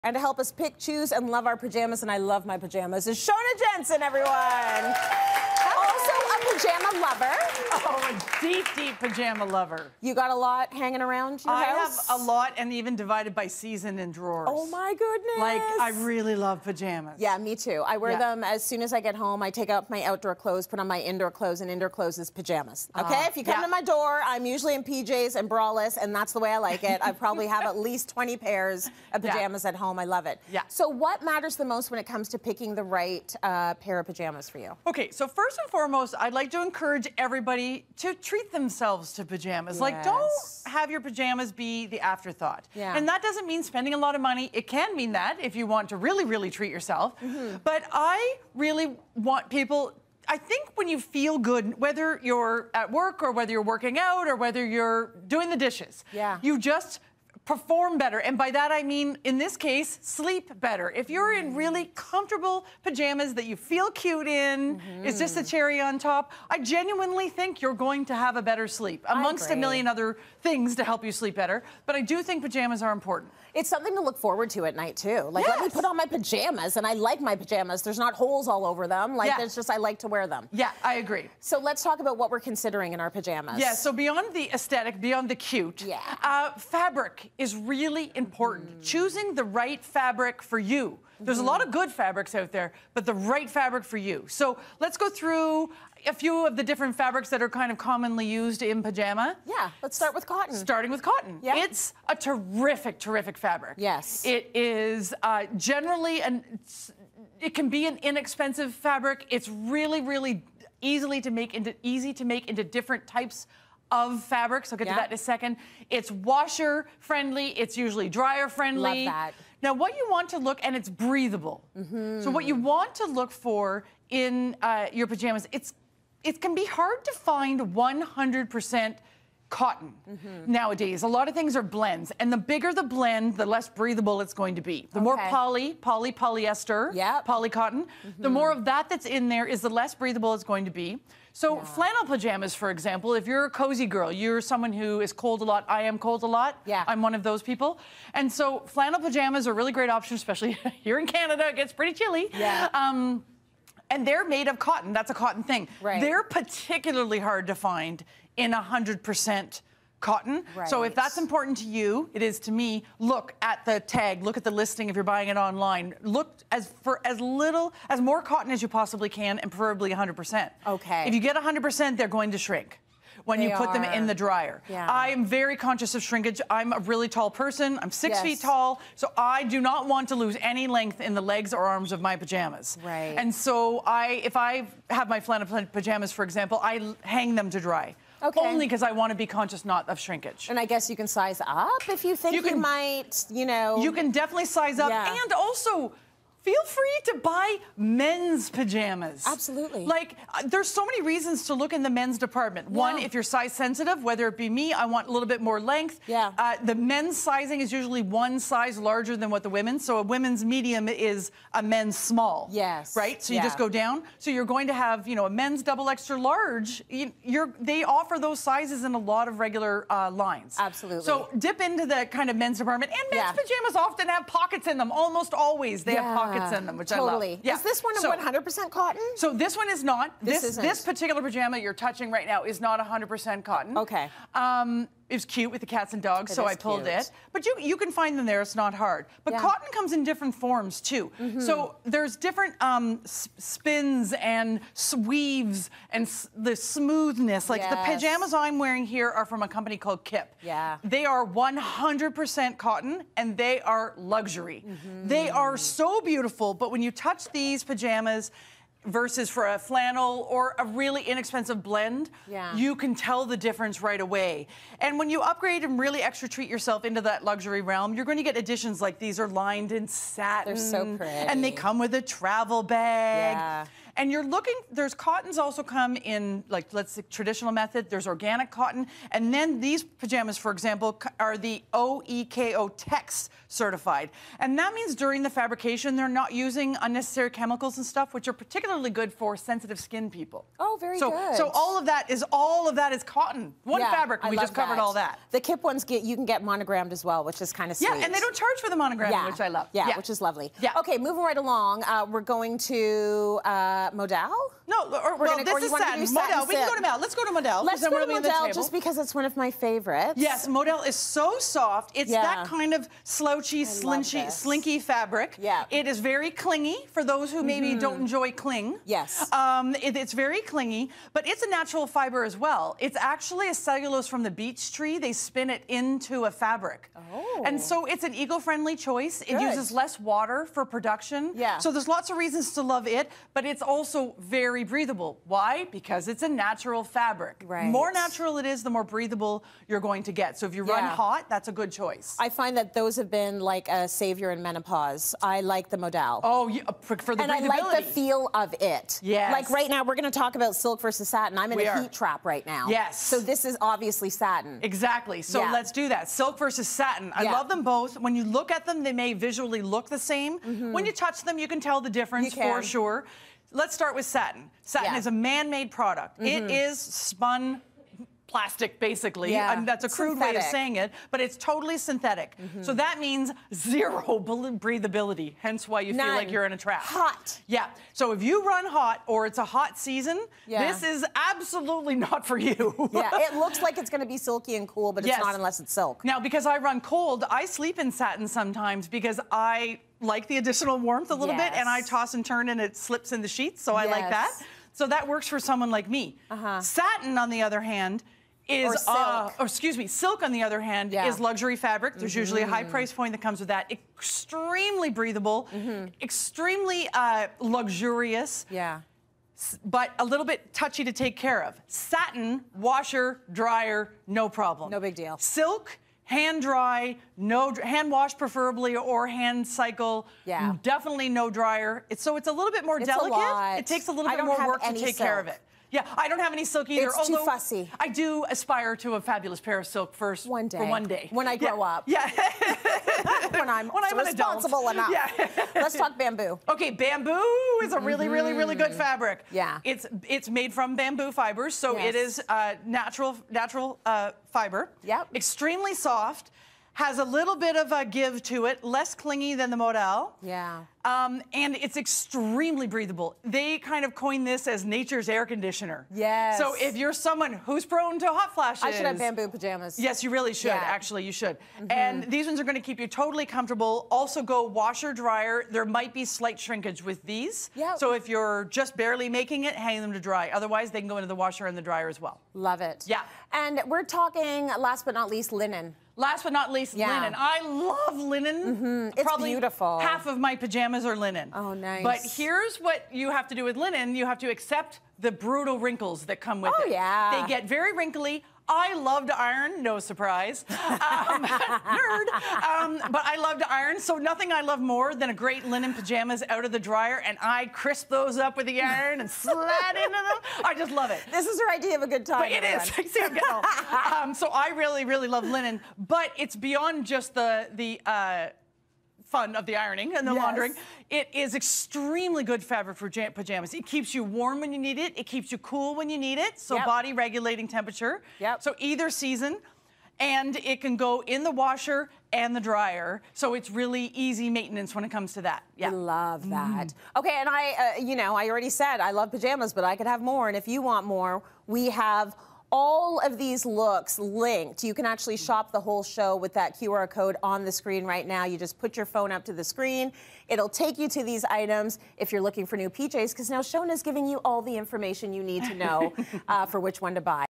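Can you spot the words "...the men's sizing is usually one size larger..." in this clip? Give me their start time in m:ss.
3:26.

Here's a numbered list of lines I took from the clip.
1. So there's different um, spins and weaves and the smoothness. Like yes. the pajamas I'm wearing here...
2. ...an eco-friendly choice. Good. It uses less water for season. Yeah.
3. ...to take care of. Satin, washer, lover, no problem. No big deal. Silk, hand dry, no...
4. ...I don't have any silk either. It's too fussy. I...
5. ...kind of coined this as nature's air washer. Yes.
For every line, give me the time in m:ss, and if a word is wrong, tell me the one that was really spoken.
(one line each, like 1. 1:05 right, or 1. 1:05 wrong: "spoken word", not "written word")
1. 4:01 right
2. 5:28 wrong: "production", not "season"
3. 6:50 wrong: "dryer", not "lover"
4. 7:05 right
5. 7:33 wrong: "conditioner", not "washer".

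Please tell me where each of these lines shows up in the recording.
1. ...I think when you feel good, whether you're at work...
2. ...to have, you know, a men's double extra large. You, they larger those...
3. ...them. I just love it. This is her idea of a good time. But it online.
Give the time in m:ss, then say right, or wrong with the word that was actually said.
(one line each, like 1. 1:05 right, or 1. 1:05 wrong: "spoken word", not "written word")
1. 0:50 right
2. 3:34 wrong: "offer", not "larger"
3. 8:19 wrong: "everyone", not "online".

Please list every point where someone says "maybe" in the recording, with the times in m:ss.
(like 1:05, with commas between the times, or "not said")
5:17.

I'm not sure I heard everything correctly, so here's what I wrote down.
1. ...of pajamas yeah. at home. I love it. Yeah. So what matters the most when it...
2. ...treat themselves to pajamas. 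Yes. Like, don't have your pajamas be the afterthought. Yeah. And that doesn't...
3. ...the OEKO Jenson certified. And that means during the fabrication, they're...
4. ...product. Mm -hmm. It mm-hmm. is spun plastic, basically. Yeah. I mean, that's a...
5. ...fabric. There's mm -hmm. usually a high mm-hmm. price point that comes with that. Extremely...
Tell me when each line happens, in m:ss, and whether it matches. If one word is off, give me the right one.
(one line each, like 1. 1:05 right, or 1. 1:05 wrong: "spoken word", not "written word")
1. 0:29 right
2. 0:38 right
3. 4:41 wrong: "Tex", not "Jenson"
4. 6:05 right
5. 6:41 right.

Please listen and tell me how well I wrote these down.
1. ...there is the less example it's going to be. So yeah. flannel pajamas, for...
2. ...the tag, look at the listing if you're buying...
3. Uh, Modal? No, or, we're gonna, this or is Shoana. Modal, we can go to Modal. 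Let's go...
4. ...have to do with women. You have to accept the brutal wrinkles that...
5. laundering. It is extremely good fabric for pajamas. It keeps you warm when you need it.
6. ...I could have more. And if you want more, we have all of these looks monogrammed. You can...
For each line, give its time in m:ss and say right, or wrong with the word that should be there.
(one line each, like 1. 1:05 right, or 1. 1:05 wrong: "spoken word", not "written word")
1. 2:19 wrong: "breathable", not "example"
2. 2:43 right
3. 5:03 wrong: "Satin", not "Shoana"
4. 8:03 wrong: "linen", not "women"
5. 8:30 right
6. 8:49 wrong: "linked", not "monogrammed".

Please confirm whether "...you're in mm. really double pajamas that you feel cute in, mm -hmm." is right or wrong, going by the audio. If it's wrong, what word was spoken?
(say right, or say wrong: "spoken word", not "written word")
wrong: "comfortable", not "double".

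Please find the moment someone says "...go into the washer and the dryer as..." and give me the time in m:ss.
7:50.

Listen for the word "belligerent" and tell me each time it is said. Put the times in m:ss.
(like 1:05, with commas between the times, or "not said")
not said.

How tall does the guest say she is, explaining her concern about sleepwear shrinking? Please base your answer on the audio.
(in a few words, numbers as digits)
6 feet.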